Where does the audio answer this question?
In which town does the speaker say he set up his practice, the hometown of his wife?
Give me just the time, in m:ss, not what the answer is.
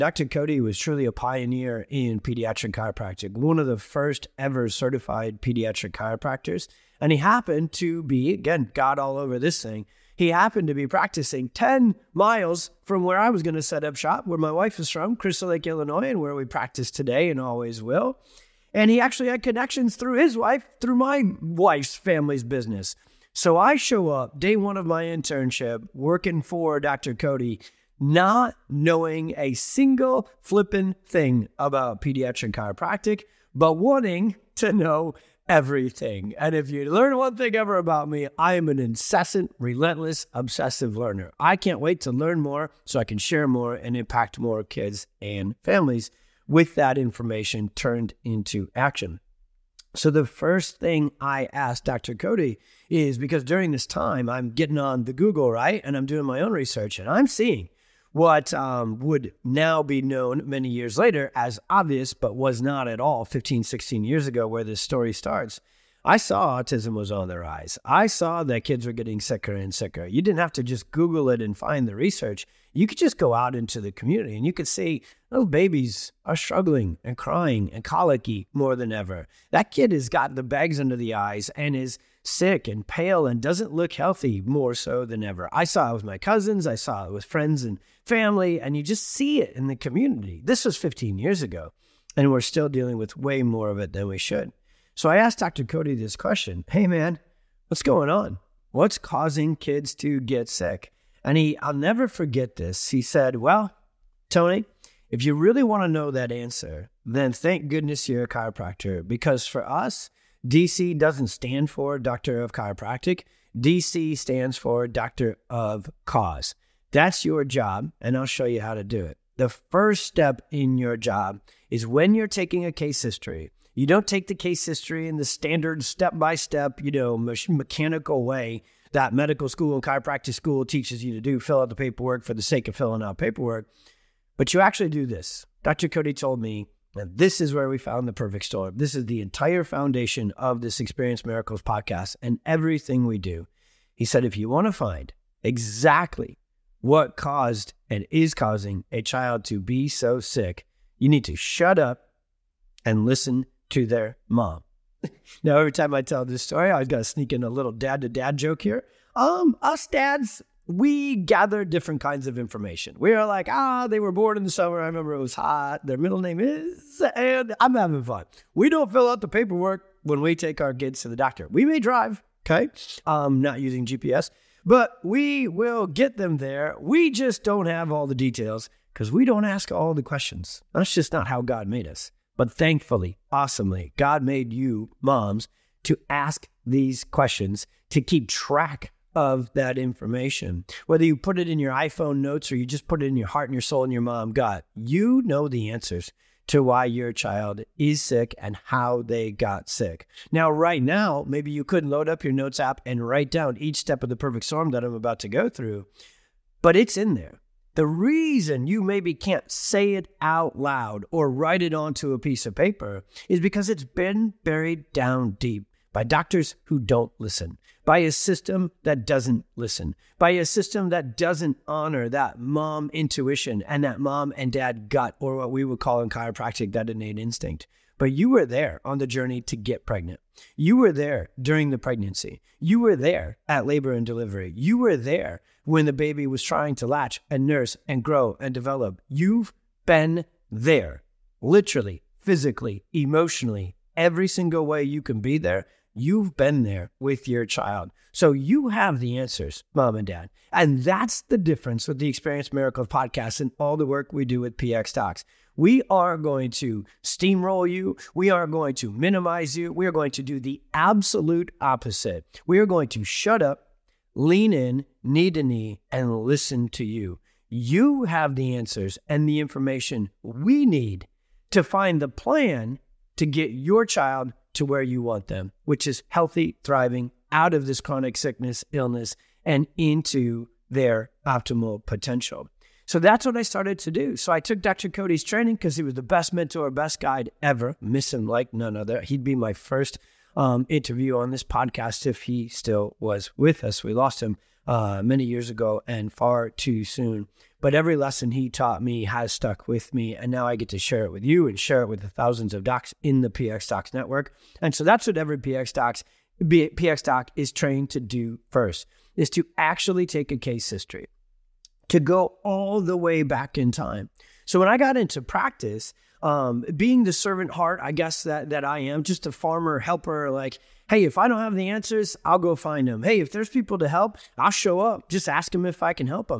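0:15.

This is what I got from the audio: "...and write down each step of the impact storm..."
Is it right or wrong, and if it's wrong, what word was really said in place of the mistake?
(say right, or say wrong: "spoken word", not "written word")
wrong: "perfect", not "impact".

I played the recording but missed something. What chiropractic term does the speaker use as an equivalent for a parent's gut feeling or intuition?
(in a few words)
innate instinct.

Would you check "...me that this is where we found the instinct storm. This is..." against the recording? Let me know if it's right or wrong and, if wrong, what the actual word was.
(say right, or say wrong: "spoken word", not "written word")
wrong: "perfect", not "instinct".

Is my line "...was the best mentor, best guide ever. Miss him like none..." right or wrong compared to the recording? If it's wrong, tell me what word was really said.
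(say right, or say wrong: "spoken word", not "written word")
right.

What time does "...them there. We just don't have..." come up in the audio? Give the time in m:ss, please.
2:56.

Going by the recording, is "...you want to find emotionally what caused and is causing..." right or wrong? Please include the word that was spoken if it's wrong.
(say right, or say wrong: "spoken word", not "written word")
wrong: "exactly", not "emotionally".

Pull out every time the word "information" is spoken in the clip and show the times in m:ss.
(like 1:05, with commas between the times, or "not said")
0:46, 2:42, 3:09, 4:29.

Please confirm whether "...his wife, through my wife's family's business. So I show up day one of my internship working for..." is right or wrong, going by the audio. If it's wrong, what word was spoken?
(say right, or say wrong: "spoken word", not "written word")
right.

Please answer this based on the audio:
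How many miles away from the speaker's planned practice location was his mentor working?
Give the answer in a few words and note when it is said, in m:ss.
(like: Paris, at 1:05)
10, at 0:11.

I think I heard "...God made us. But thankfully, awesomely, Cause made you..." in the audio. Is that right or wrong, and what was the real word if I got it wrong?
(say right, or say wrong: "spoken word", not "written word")
wrong: "God", not "Cause".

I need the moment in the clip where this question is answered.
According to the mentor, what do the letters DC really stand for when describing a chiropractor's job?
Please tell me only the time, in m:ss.
1:54.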